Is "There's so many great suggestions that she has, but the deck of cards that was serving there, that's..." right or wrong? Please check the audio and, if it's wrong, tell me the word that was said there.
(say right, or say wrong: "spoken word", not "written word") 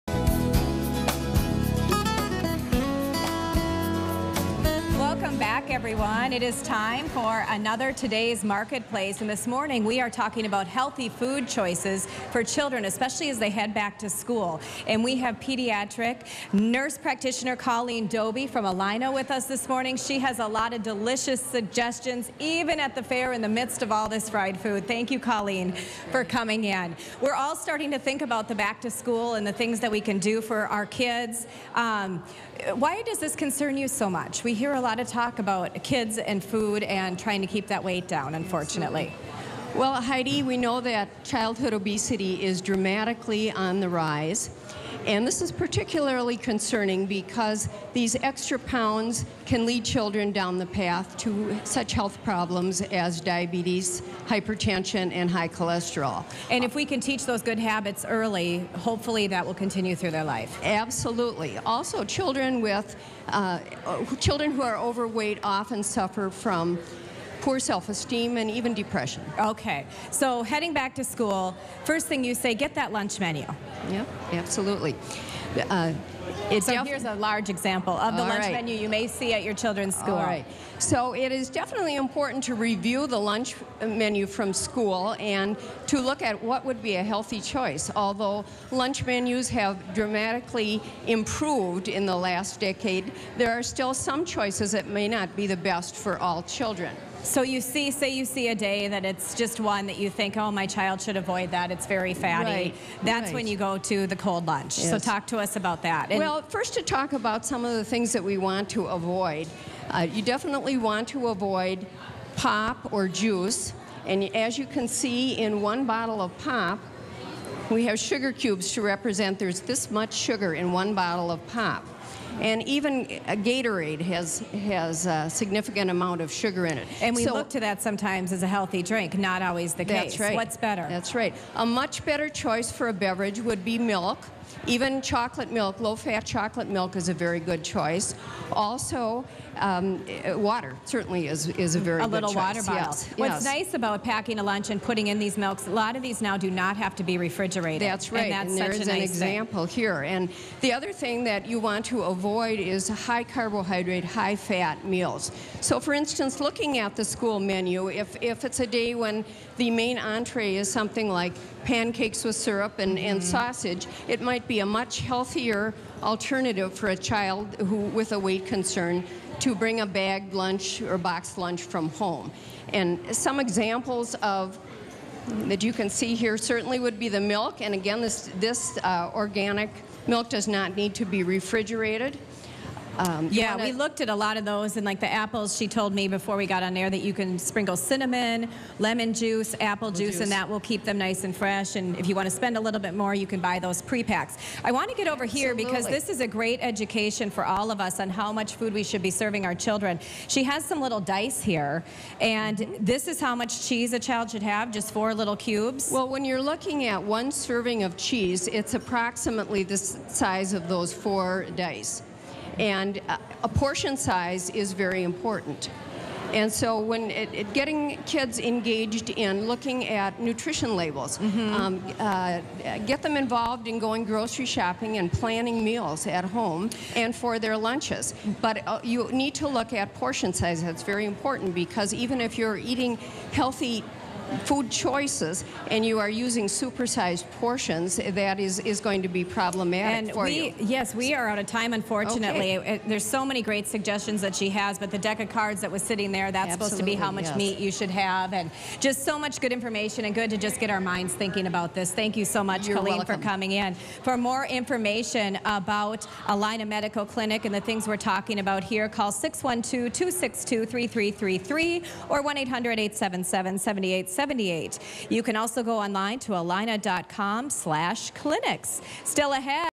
wrong: "sitting", not "serving".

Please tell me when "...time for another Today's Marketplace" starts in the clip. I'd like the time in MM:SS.
00:06.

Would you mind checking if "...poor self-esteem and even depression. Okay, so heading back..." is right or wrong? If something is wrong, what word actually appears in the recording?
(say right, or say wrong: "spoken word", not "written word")
right.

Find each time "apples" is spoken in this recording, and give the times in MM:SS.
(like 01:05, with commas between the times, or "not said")
03:05, 03:09.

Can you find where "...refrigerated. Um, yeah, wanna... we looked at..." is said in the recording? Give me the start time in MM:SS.
03:01.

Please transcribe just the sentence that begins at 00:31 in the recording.
Um, why does this concern you so much?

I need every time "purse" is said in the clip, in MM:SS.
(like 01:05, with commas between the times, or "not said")
not said.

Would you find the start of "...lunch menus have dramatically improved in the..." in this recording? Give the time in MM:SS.
01:28.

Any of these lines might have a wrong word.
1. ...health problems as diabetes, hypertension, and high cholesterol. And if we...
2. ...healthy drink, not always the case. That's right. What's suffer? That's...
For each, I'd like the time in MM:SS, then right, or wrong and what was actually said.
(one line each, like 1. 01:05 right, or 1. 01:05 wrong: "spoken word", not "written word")
1. 00:51 right
2. 02:08 wrong: "better", not "suffer".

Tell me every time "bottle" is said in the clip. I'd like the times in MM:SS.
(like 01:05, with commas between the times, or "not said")
01:55, 02:00, 02:22.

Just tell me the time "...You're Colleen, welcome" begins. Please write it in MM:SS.
04:12.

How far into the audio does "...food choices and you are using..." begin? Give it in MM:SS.
03:54.